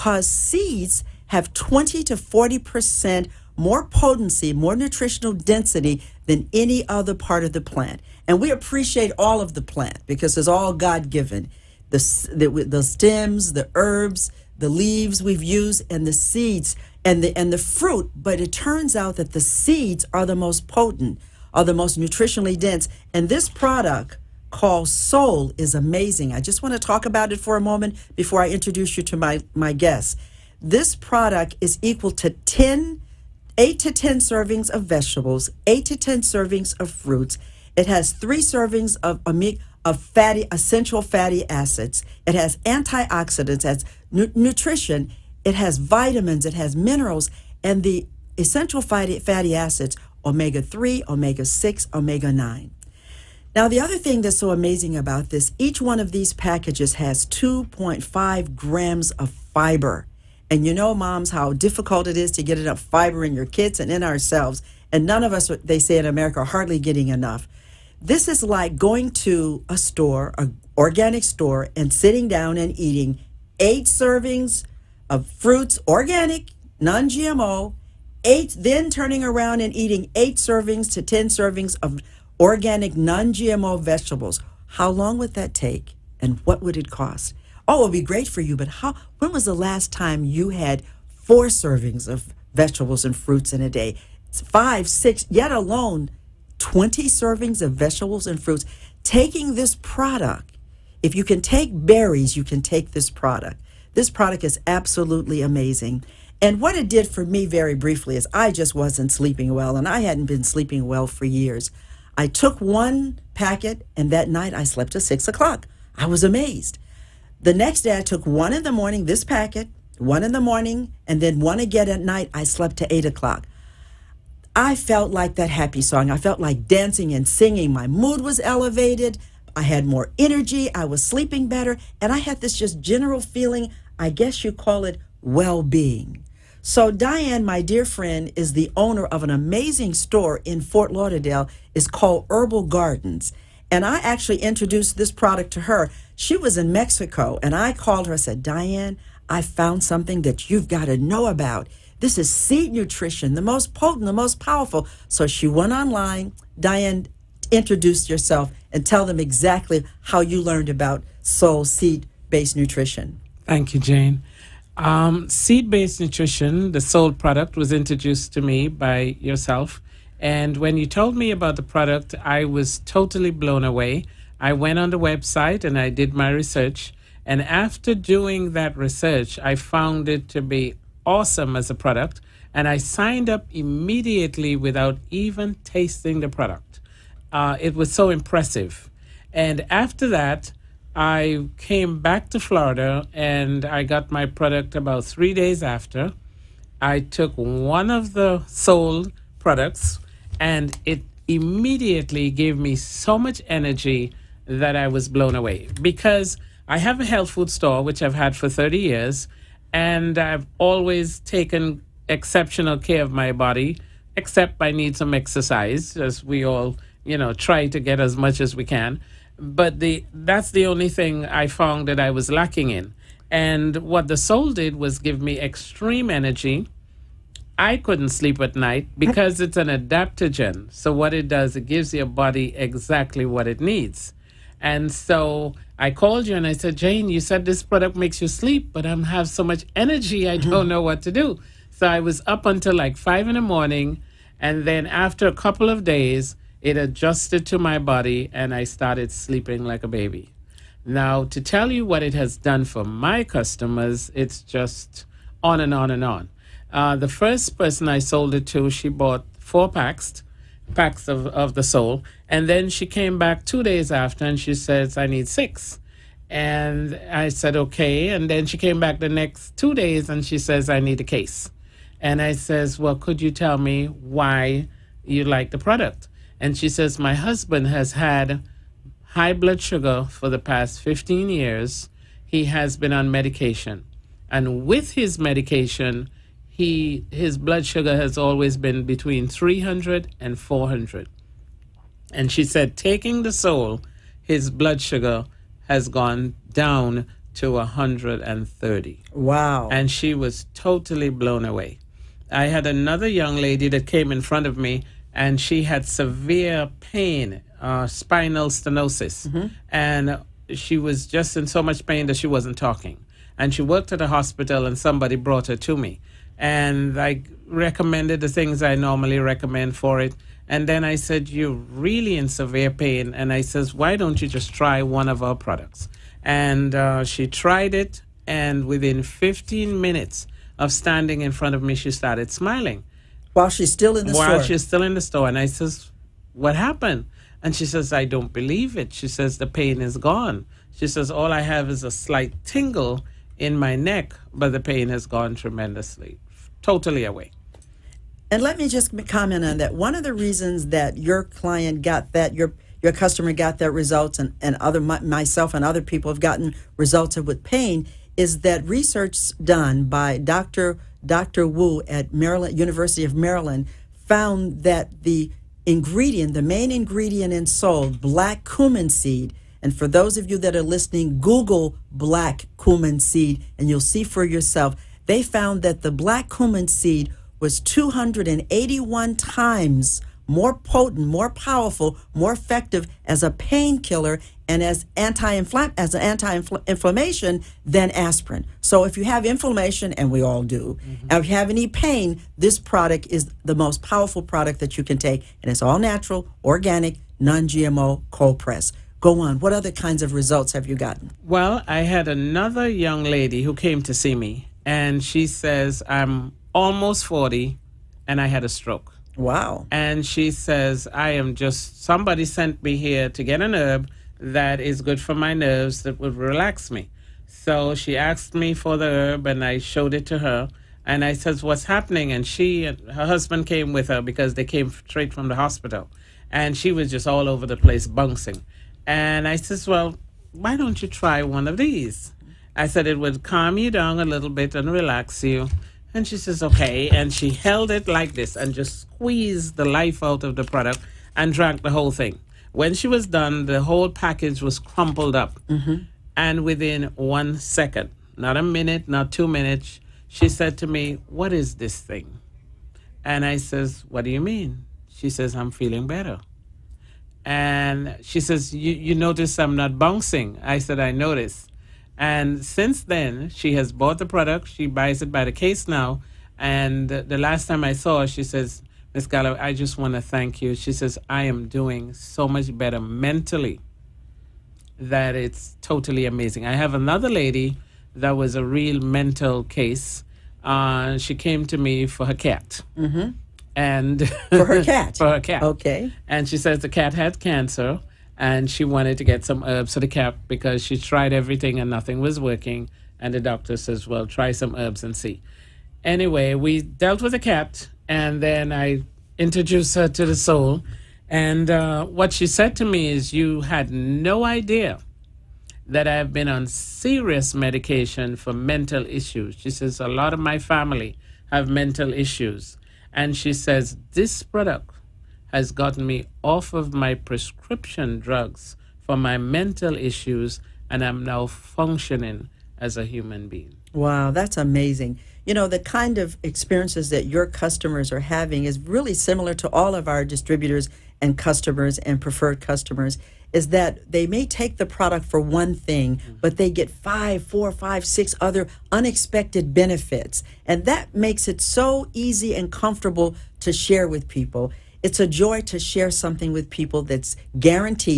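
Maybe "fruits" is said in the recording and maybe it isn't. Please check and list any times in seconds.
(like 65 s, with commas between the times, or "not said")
17 s, 36 s, 75 s, 93 s, 98 s.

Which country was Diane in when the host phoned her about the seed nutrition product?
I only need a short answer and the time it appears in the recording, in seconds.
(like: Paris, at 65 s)
Mexico, at 146 s.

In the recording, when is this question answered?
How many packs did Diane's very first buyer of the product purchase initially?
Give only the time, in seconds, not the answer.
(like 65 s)
259 s.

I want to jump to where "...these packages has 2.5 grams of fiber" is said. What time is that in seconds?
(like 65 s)
56 s.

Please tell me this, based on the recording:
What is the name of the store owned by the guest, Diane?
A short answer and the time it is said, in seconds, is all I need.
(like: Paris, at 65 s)
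Herbal Gardens, at 142 s.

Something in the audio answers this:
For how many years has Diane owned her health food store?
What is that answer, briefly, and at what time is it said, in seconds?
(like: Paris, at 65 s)
30, at 208 s.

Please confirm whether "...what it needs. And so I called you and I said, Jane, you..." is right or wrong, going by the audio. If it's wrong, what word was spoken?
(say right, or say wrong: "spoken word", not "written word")
right.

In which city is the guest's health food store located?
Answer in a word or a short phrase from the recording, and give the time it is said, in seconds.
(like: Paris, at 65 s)
Fort Lauderdale, at 140 s.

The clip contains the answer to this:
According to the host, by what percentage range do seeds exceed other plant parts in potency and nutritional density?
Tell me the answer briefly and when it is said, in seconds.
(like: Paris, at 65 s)
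20 to 40%, at 1 s.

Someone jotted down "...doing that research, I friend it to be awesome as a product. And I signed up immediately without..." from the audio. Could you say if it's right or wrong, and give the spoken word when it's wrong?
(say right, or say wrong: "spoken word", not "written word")
wrong: "found", not "friend".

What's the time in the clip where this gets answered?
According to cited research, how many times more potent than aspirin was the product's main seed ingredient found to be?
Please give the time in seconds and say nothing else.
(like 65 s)
377 s.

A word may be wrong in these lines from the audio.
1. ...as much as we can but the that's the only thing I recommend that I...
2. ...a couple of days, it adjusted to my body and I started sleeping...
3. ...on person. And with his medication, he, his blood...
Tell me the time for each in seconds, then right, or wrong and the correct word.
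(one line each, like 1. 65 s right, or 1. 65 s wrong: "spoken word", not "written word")
1. 217 s wrong: "found", not "recommend"
2. 245 s right
3. 282 s wrong: "medication", not "person".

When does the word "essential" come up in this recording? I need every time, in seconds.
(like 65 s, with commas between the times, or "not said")
40 s, 48 s.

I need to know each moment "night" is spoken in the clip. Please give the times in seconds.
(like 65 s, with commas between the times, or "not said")
114 s, 122 s, 228 s.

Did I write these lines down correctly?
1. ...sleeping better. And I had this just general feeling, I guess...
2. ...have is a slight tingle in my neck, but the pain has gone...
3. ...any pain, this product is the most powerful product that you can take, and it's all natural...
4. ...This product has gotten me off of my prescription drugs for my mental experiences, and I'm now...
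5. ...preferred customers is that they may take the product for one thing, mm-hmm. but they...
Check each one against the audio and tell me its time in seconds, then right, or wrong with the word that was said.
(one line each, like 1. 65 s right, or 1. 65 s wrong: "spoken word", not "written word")
1. 131 s right
2. 341 s right
3. 391 s right
4. 513 s wrong: "issues", not "experiences"
5. 531 s right.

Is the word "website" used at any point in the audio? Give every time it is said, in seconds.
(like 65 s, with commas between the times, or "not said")
174 s.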